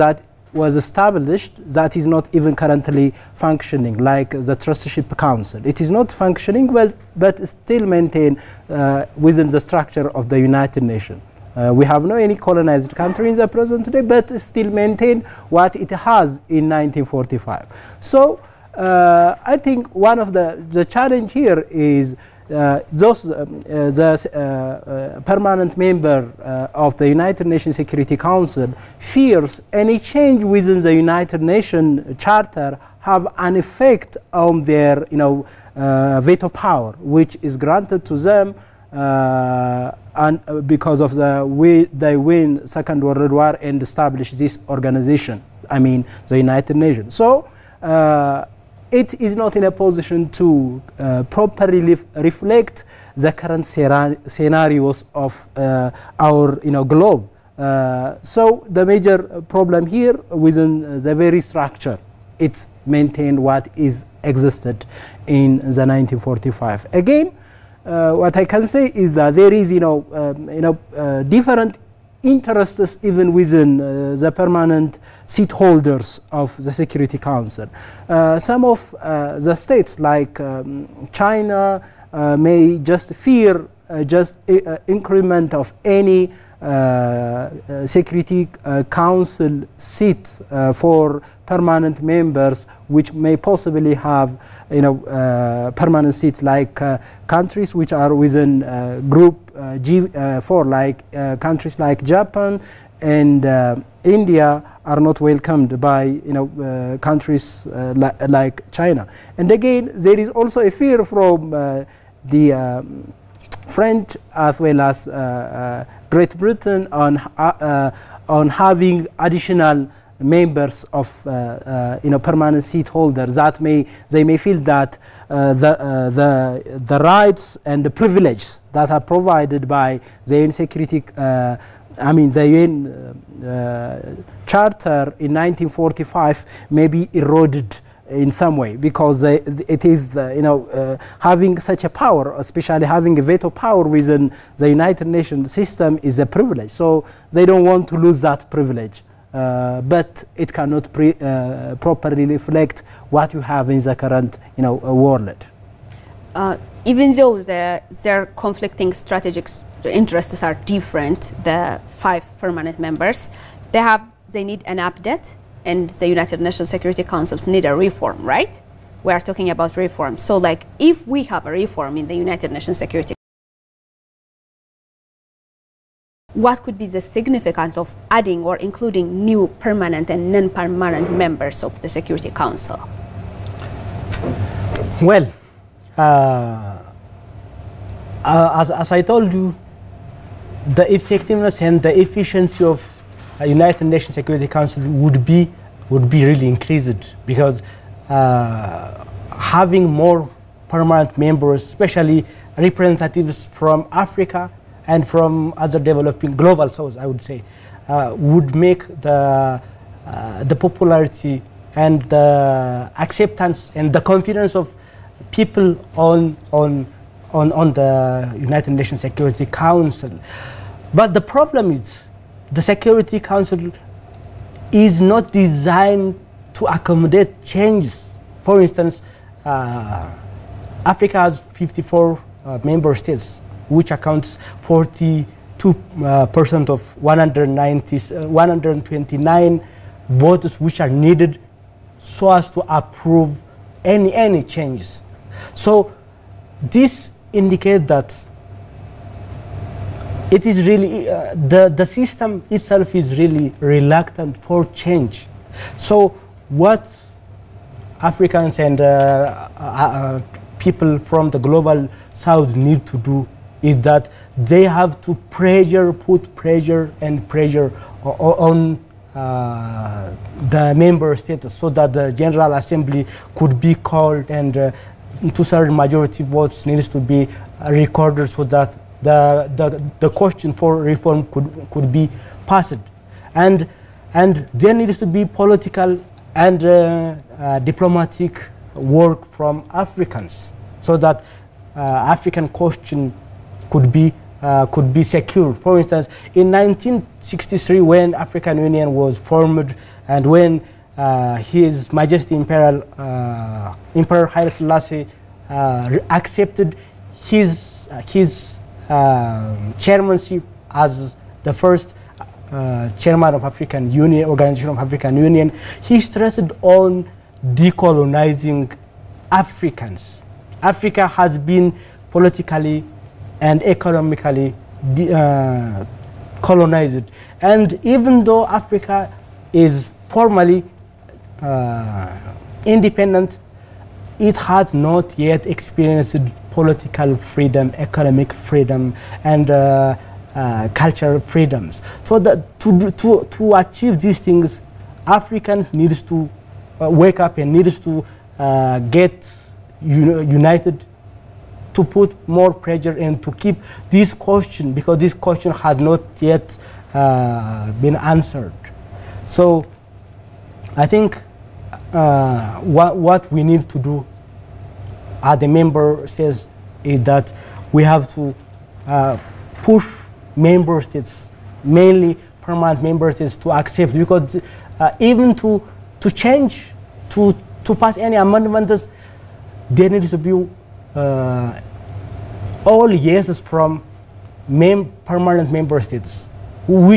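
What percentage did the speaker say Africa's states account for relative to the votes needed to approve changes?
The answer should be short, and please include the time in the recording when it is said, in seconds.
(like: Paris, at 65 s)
42%, at 234 s.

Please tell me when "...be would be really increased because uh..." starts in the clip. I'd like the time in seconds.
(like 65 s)
195 s.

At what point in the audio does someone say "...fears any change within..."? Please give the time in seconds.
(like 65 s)
28 s.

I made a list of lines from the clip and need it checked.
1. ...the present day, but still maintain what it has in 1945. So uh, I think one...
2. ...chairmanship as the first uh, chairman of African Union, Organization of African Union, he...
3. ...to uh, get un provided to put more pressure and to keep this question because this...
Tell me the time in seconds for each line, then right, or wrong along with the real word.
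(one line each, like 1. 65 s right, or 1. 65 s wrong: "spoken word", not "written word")
1. 13 s right
2. 309 s right
3. 347 s wrong: "united", not "provided".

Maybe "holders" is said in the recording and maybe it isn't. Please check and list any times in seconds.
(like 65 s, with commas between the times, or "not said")
75 s, 122 s.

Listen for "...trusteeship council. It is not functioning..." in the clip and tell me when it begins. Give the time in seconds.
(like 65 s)
4 s.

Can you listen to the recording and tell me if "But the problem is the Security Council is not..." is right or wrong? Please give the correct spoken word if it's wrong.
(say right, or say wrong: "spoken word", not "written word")
right.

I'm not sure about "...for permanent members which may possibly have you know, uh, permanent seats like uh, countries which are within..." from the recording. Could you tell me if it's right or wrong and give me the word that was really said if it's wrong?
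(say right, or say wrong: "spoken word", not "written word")
right.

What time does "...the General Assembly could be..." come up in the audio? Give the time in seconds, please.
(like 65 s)
271 s.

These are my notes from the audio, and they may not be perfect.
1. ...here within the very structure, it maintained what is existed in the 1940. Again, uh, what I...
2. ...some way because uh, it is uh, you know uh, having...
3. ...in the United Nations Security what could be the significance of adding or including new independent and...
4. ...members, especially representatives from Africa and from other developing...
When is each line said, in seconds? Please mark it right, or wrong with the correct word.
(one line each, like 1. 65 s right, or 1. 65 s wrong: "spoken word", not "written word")
1. 59 s wrong: "1945", not "1940"
2. 138 s right
3. 171 s wrong: "permanent", not "independent"
4. 201 s right.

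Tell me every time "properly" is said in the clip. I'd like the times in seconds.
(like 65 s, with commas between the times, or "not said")
51 s, 151 s.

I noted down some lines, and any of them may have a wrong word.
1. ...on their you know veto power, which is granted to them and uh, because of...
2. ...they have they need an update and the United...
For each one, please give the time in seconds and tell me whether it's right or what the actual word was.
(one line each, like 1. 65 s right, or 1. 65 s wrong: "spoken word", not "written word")
1. 34 s right
2. 163 s right.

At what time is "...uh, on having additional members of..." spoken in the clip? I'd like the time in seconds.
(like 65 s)
117 s.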